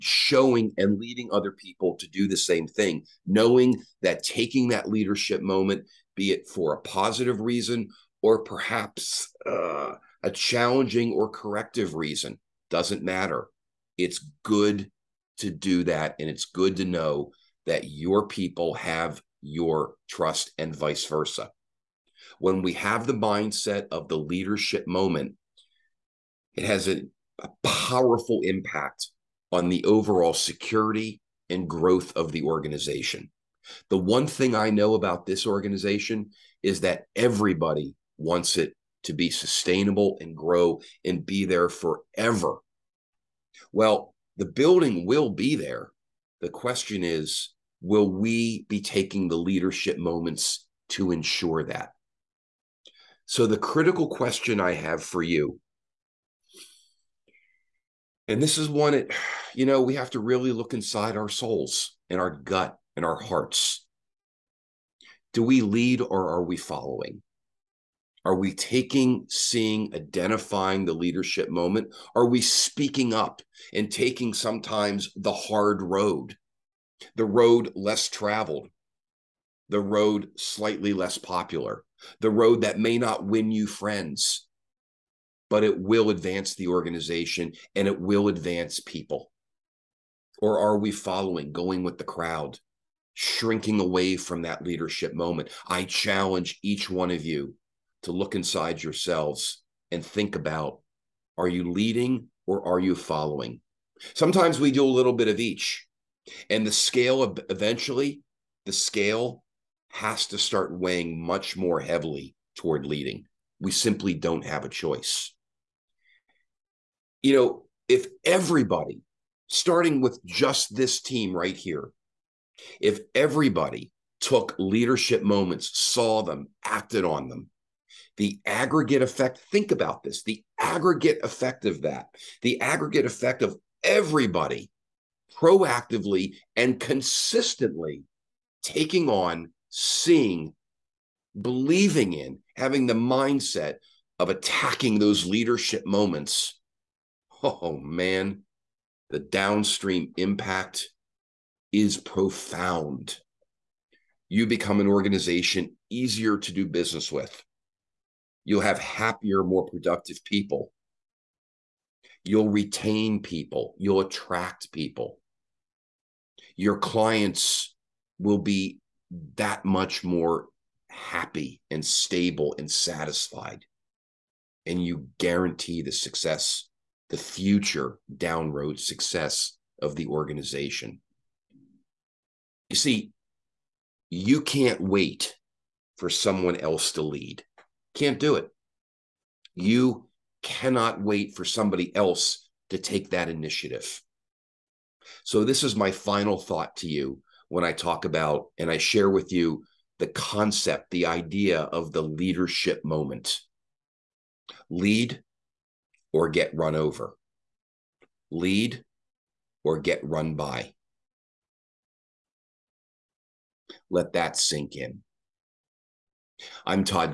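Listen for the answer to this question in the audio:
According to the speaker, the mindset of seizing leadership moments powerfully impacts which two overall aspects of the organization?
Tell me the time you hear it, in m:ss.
0:30.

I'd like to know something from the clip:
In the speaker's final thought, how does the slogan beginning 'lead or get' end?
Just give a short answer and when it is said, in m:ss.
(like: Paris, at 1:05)
run over, at 3:26.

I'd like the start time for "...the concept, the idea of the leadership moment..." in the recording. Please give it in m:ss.
3:19.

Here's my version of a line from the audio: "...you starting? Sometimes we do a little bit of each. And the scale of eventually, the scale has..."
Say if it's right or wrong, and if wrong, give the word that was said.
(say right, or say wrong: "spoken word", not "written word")
wrong: "following", not "starting".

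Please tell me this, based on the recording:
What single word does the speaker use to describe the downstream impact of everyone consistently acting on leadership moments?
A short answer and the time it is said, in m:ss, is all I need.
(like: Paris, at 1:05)
profound, at 2:31.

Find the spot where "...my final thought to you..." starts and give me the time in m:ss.
3:15.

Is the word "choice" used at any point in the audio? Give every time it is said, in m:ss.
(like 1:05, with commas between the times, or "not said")
1:54.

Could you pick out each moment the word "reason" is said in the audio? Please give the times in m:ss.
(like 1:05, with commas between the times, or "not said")
0:07, 0:11.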